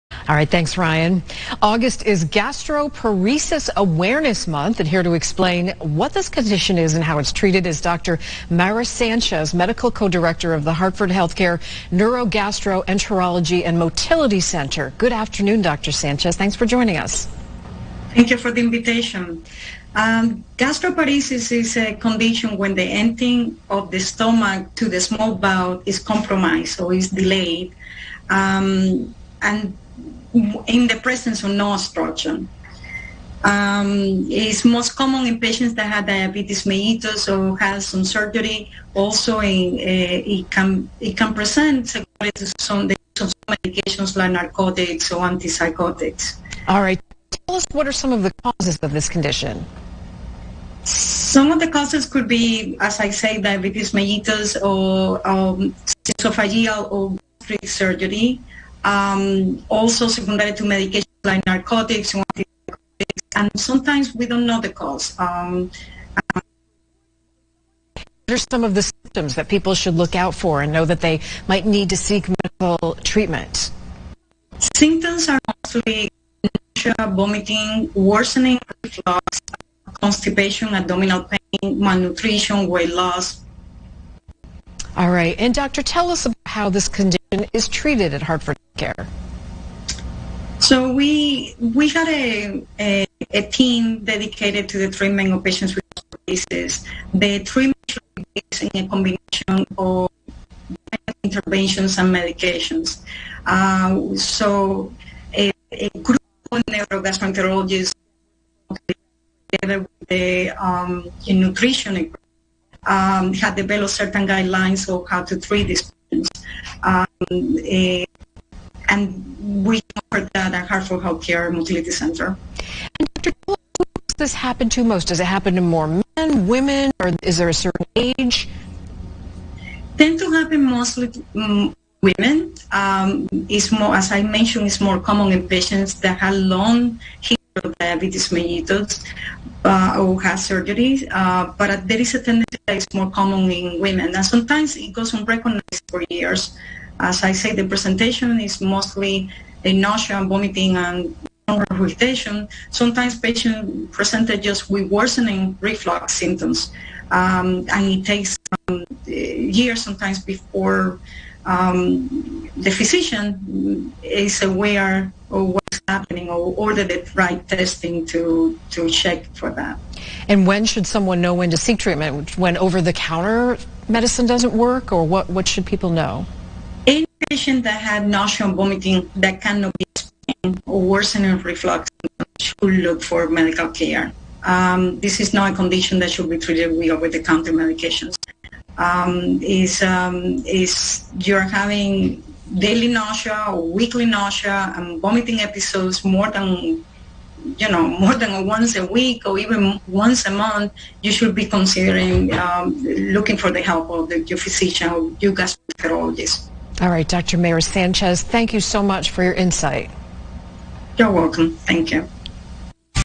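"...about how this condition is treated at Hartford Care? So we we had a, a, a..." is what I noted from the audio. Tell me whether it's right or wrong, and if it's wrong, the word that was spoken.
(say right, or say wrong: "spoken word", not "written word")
right.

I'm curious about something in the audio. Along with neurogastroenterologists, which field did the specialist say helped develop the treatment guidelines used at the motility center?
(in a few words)
Nutrition.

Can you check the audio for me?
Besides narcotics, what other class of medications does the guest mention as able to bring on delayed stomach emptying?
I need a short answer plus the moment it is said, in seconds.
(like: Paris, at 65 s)
Antipsychotics, at 45 s.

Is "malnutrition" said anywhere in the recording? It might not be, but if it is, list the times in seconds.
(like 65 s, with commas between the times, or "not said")
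81 s.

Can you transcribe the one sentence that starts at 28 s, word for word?
Um, and in the presence of no obstruction.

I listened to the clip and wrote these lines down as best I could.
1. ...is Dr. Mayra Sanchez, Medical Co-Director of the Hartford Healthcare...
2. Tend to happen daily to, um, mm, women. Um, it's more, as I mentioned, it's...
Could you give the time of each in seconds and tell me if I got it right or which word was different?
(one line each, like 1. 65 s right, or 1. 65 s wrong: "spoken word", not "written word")
1. 7 s right
2. 129 s wrong: "mostly", not "daily".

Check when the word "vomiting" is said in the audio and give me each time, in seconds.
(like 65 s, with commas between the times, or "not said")
77 s, 150 s, 178 s, 195 s.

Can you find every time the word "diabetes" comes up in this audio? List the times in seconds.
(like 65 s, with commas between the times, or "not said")
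36 s, 53 s, 137 s.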